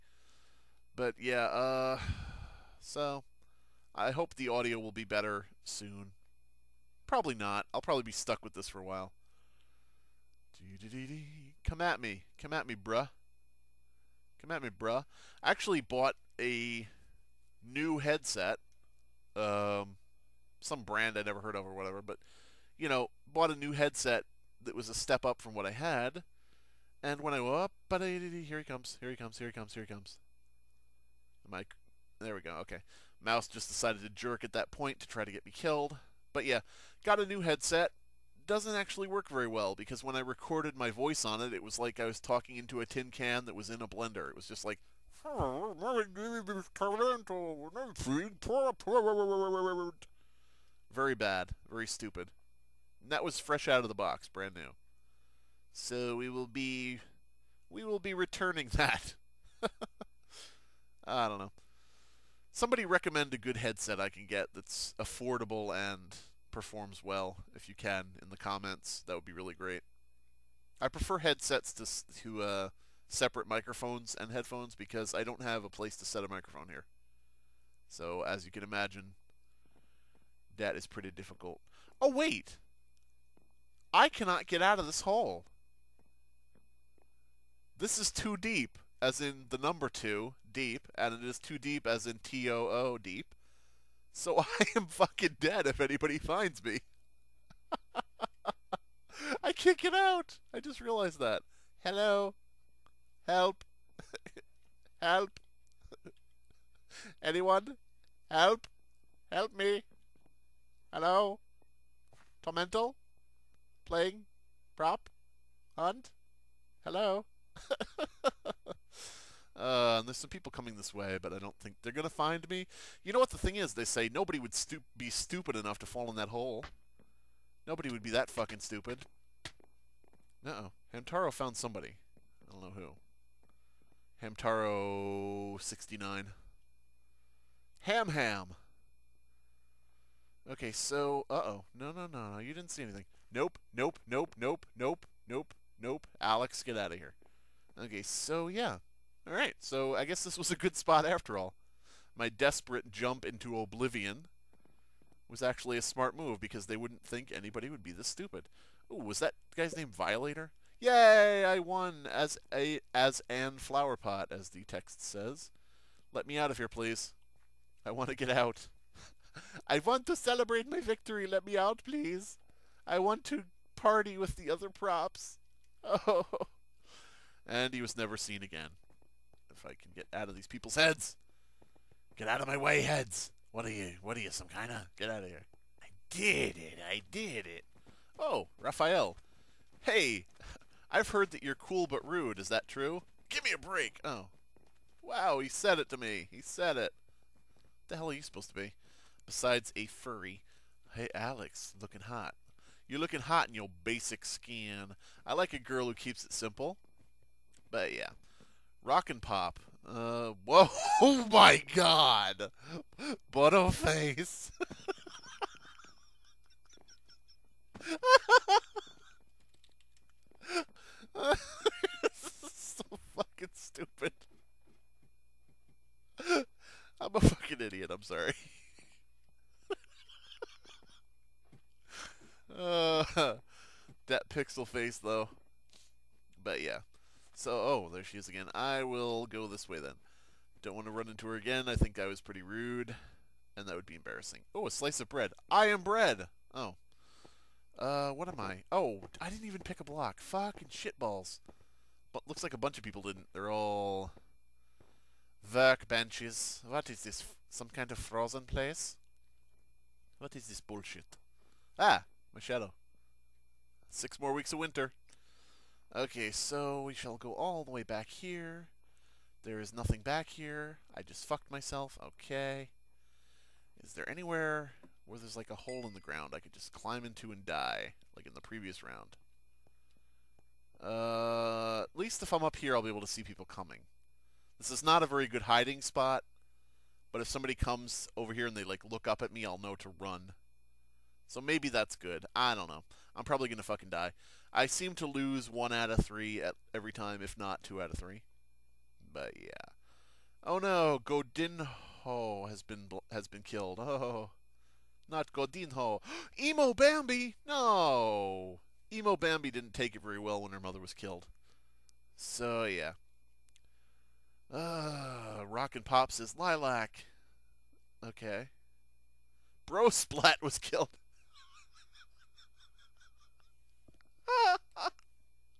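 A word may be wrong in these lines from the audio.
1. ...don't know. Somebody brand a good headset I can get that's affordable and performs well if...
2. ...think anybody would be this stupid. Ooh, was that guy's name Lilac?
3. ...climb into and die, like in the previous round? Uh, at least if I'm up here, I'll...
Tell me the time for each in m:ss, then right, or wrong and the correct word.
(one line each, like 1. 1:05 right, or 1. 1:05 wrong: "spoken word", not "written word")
1. 1:01 wrong: "recommend", not "brand"
2. 2:37 wrong: "Violator", not "Lilac"
3. 4:36 right.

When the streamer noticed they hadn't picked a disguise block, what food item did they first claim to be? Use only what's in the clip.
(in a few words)
a slice of bread.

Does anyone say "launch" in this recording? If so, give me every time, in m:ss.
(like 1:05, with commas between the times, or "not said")
not said.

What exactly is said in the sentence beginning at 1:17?
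So as you can imagine, that is pretty difficult.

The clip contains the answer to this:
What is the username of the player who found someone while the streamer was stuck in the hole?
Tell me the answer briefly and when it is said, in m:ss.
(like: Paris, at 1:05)
Hamtaro69, at 2:14.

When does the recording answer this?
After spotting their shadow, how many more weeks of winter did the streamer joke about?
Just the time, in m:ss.
4:23.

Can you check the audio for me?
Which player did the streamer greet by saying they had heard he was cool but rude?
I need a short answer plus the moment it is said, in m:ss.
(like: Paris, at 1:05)
Raphael, at 3:08.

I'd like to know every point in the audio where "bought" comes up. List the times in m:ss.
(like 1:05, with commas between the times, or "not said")
0:15, 0:23.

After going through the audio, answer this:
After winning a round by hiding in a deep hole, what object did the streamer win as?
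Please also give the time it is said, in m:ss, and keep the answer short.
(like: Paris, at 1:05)
flower pot, at 2:43.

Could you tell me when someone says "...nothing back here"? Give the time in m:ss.
4:29.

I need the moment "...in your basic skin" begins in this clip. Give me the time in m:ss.
3:23.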